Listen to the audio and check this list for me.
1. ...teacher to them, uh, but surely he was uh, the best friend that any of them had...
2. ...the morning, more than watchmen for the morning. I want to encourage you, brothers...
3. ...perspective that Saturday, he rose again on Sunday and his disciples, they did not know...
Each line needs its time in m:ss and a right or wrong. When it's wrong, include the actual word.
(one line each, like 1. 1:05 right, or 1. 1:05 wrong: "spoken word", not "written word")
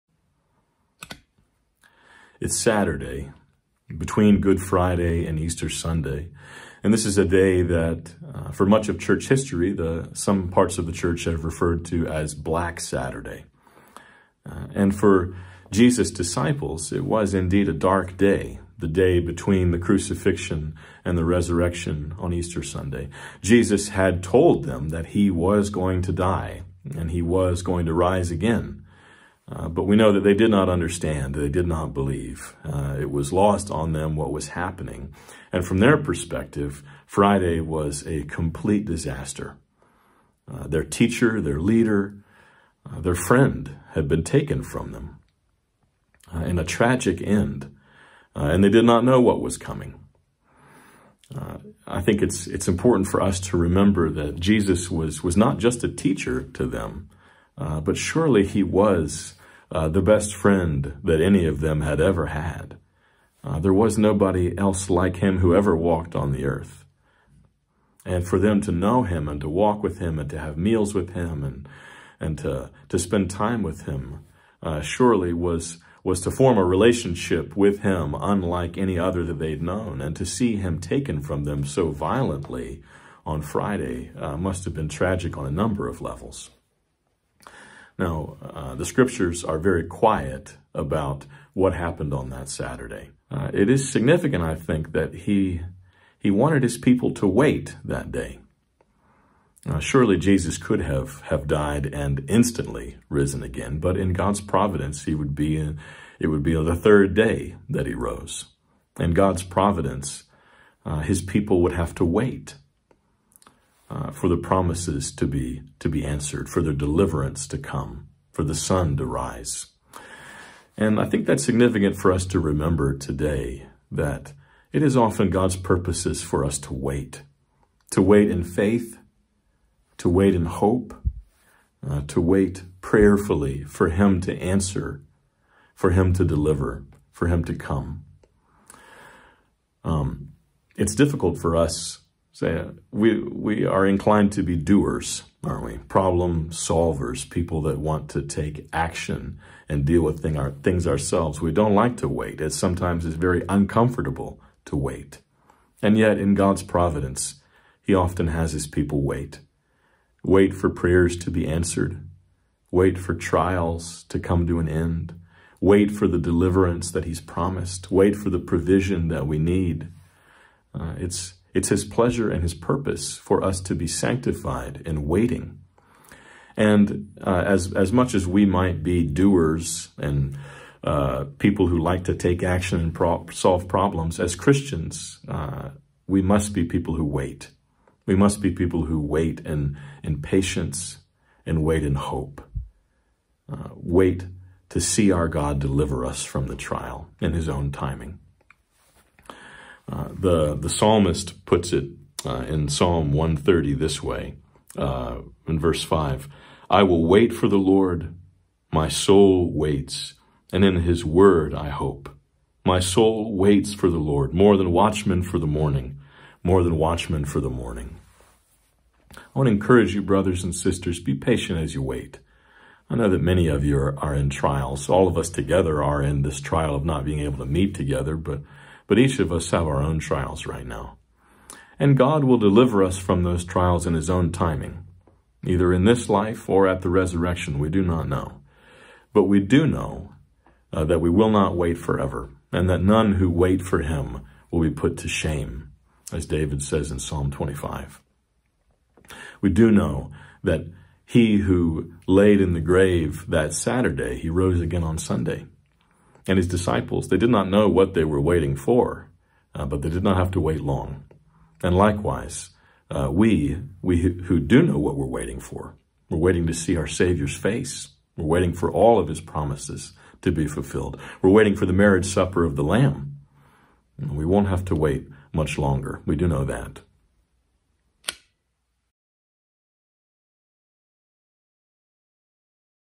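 1. 0:55 right
2. 3:35 right
3. 4:12 wrong: "grave", not "perspective".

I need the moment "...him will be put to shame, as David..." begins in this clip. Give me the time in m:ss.
4:03.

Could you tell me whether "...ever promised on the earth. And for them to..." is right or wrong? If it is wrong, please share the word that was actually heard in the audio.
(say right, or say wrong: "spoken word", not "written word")
wrong: "walked", not "promised".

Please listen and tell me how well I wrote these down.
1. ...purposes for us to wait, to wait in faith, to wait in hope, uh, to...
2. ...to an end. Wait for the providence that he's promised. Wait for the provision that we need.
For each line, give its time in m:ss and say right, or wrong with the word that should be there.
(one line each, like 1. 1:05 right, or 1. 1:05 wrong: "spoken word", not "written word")
1. 2:05 right
2. 2:44 wrong: "deliverance", not "providence".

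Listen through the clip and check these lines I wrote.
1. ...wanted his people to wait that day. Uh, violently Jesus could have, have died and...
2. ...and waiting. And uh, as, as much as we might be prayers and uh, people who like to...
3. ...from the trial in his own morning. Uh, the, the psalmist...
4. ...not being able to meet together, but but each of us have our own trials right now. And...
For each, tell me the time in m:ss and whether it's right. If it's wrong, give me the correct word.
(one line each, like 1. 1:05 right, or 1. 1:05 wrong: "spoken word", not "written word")
1. 1:36 wrong: "surely", not "violently"
2. 2:54 wrong: "doers", not "prayers"
3. 3:16 wrong: "timing", not "morning"
4. 3:46 right.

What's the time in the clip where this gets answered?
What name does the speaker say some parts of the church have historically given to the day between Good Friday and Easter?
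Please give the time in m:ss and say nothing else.
0:12.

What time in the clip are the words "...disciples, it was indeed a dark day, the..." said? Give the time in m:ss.
0:16.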